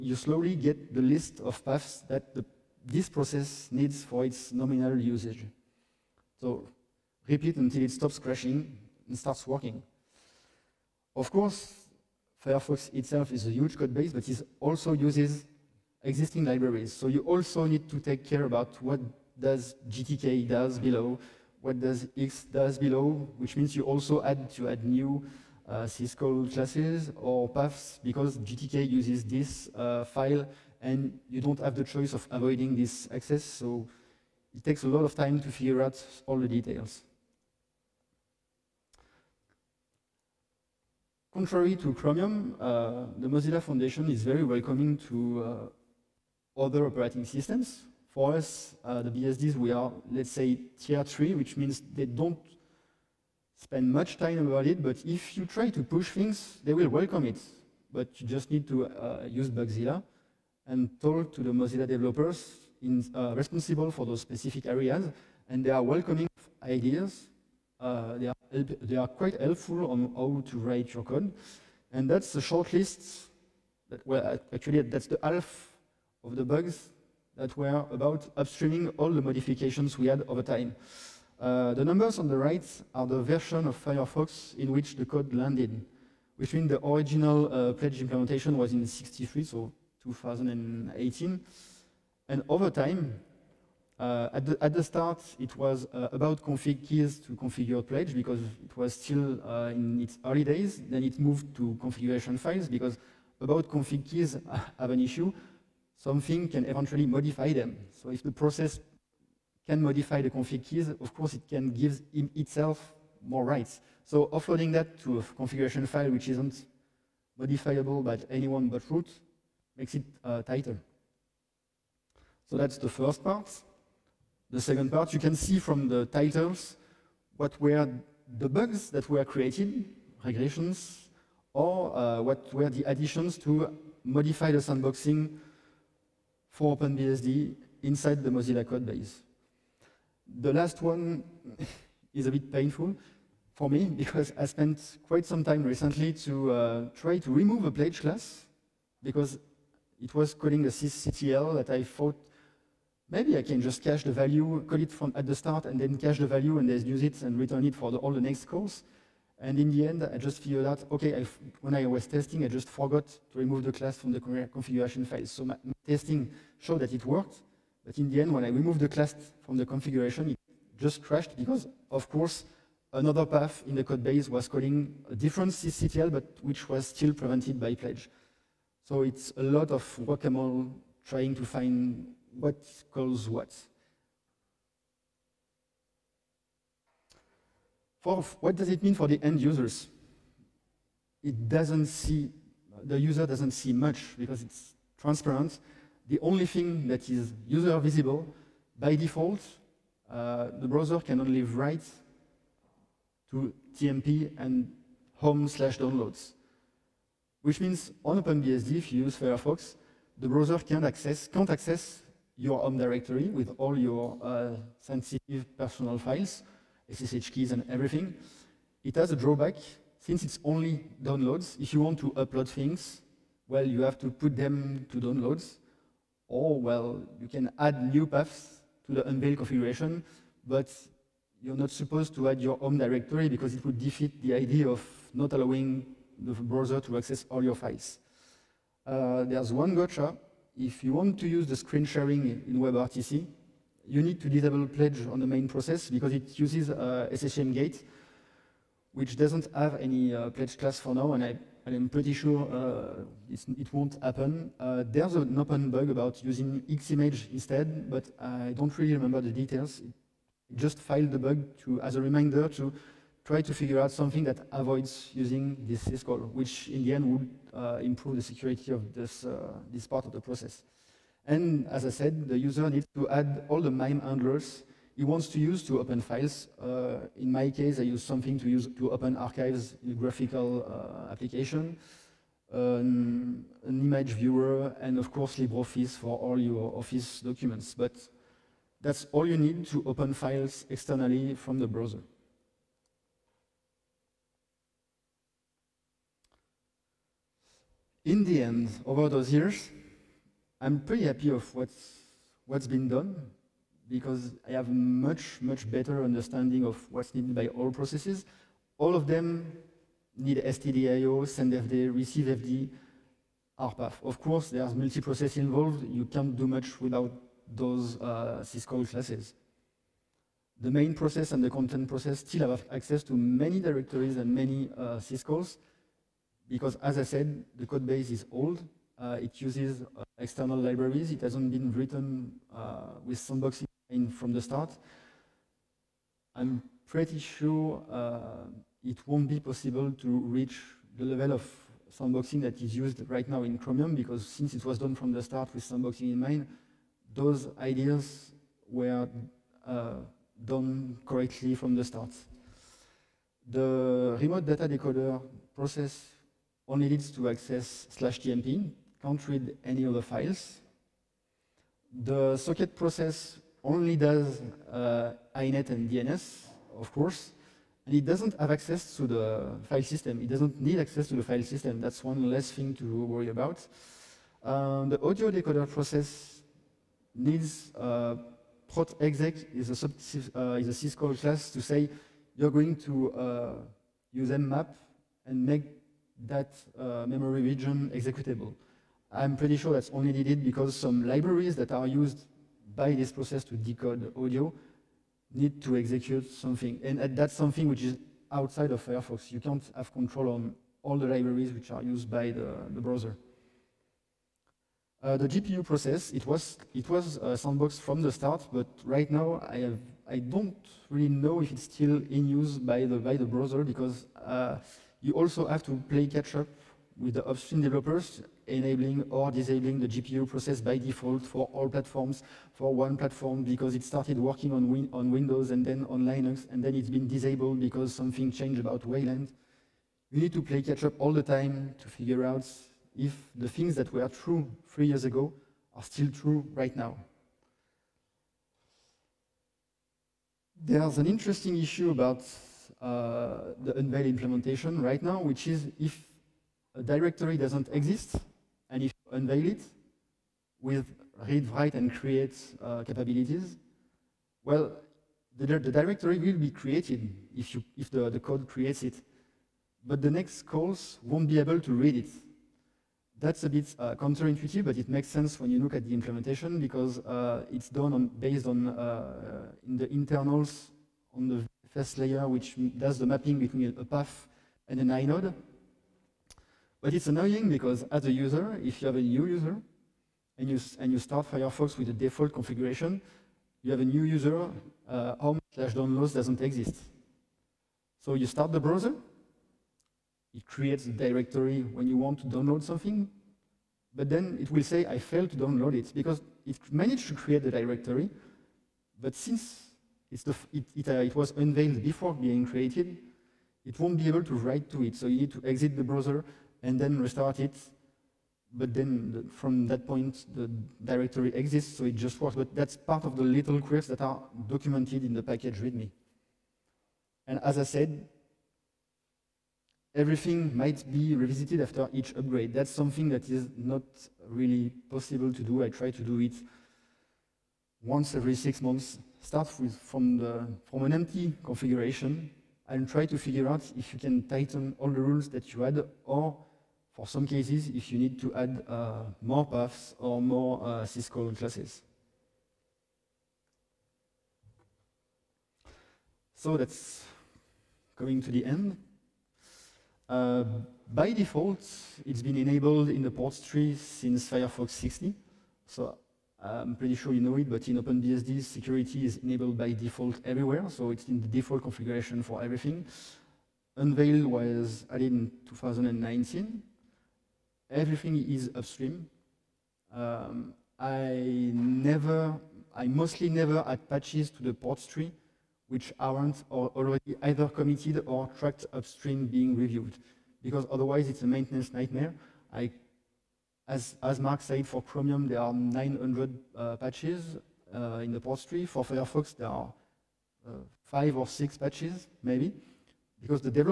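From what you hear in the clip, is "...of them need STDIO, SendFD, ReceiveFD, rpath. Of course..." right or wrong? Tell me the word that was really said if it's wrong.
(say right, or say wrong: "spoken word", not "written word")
right.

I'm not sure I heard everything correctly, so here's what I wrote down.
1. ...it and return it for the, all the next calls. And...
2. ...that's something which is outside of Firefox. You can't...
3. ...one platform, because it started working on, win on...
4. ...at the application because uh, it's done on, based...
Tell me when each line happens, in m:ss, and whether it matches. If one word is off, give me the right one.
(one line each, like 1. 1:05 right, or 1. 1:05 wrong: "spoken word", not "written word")
1. 2:37 right
2. 6:37 right
3. 7:02 right
4. 7:45 wrong: "implementation", not "application".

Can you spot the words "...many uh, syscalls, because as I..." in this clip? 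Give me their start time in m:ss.
5:24.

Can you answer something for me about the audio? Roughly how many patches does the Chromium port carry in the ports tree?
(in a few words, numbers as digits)
900.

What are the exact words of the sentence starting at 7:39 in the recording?
But the next calls won't be able to read it.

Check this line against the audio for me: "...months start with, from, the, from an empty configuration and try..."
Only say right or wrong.
right.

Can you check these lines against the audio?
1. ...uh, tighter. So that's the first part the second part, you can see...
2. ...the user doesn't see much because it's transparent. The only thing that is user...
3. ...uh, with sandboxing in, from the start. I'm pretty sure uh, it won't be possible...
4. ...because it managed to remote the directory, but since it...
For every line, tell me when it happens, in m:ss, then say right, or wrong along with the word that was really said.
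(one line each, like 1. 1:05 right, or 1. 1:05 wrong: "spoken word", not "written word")
1. 2:00 right
2. 3:12 right
3. 5:32 right
4. 8:15 wrong: "create", not "remote".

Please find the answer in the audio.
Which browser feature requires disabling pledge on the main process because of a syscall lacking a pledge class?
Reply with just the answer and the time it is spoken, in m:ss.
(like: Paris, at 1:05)
Screen sharing in WebRTC, at 4:01.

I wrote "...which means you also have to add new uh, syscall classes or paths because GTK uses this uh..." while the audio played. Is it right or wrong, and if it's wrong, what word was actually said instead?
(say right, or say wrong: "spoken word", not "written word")
right.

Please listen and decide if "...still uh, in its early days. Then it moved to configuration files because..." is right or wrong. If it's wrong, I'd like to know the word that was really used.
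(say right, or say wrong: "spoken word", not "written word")
right.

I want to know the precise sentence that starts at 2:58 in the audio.
So it's a lot of guacamole trying to find what calls what.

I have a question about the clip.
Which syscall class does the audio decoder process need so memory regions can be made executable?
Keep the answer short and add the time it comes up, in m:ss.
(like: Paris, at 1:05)
prot exec, at 6:18.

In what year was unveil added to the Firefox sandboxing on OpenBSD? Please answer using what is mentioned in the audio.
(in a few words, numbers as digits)
2019.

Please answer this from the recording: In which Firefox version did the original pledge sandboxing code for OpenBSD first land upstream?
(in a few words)
63.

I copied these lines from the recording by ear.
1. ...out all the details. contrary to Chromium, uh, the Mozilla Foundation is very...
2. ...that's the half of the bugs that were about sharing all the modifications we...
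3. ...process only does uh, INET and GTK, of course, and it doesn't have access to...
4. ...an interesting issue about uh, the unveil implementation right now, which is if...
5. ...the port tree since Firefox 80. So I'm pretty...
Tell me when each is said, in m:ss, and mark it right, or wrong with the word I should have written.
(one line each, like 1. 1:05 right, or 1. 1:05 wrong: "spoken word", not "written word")
1. 0:35 right
2. 1:14 wrong: "upstreaming", not "sharing"
3. 6:02 wrong: "DNS", not "GTK"
4. 7:20 right
5. 9:13 wrong: "60", not "80".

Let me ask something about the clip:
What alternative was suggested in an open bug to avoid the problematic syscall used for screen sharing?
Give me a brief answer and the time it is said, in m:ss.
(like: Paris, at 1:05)
Ximage, at 4:16.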